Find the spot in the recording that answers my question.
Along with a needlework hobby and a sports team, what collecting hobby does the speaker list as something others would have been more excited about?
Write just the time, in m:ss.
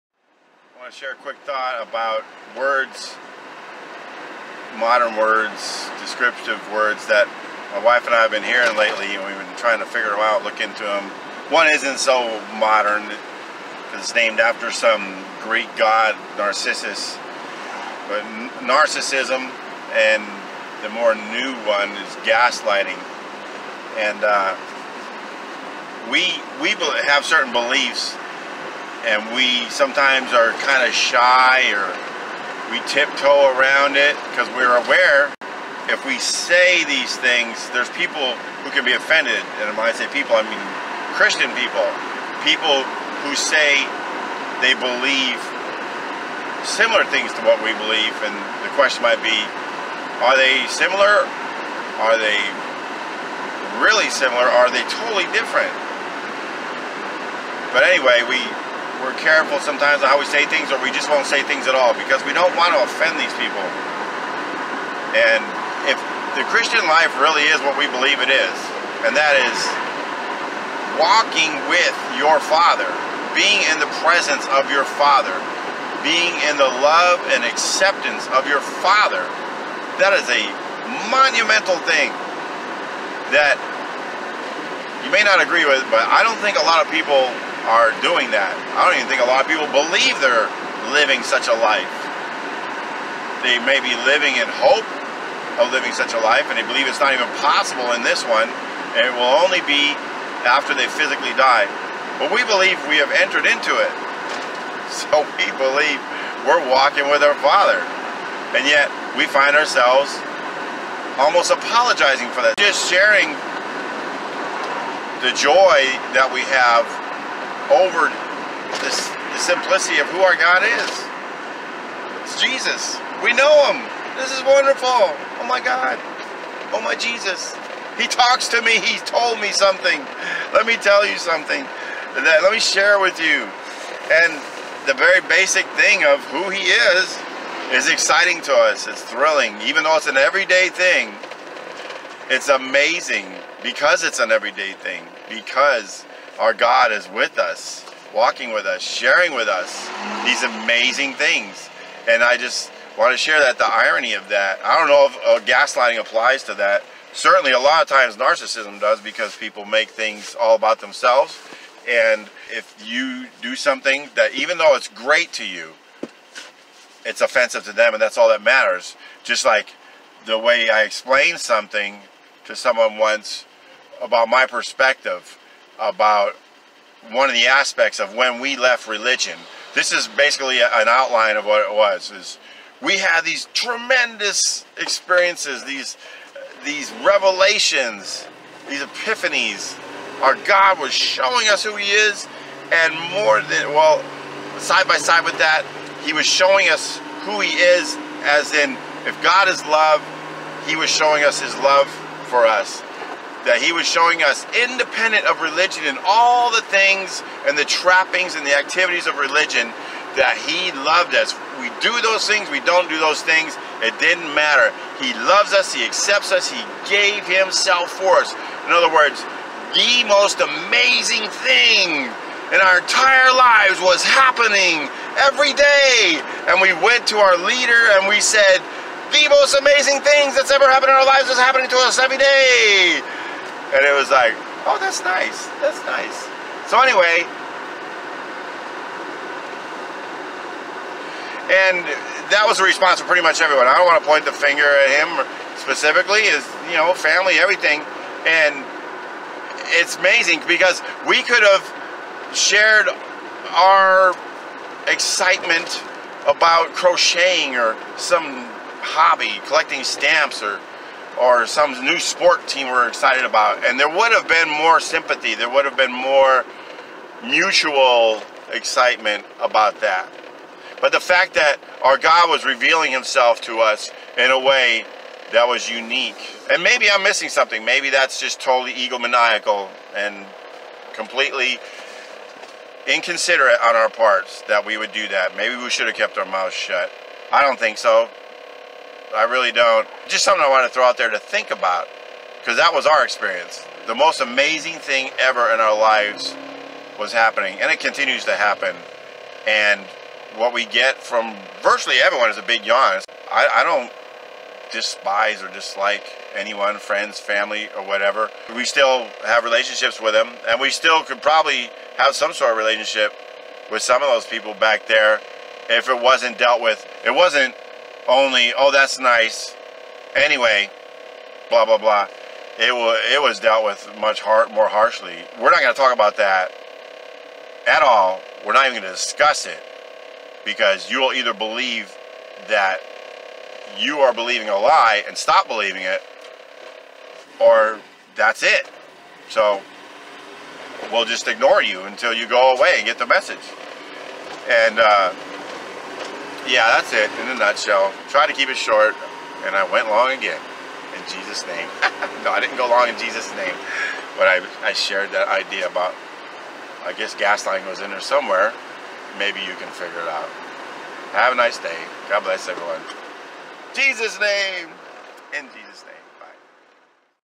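4:19.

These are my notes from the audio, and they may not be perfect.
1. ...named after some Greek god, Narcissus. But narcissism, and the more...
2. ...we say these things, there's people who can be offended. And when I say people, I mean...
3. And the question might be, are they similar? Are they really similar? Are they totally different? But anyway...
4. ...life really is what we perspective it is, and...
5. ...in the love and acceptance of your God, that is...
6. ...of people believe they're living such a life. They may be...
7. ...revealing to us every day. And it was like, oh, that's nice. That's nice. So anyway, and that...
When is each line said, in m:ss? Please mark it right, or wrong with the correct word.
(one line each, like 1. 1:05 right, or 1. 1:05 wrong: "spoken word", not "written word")
1. 0:14 right
2. 0:36 right
3. 0:48 right
4. 1:06 wrong: "believe", not "perspective"
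5. 1:16 wrong: "Father", not "God"
6. 1:29 right
7. 3:51 wrong: "happening", not "revealing".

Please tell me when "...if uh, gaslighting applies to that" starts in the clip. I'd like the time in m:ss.
2:35.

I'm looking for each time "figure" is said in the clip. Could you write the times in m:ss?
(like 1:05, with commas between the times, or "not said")
0:09, 5:59.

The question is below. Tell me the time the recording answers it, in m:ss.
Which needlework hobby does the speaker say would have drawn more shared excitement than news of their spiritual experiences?
4:16.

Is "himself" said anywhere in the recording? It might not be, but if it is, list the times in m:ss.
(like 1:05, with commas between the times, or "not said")
3:37, 4:32.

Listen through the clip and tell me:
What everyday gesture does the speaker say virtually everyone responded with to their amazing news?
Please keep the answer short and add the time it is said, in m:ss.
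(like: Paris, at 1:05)
A big yawn, at 5:02.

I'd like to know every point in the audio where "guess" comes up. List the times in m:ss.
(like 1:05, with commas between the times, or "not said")
5:56.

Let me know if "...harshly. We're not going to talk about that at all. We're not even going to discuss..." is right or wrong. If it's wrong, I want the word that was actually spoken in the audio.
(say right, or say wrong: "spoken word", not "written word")
right.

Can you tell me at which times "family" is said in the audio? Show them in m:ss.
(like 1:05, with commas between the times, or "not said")
4:06, 5:07.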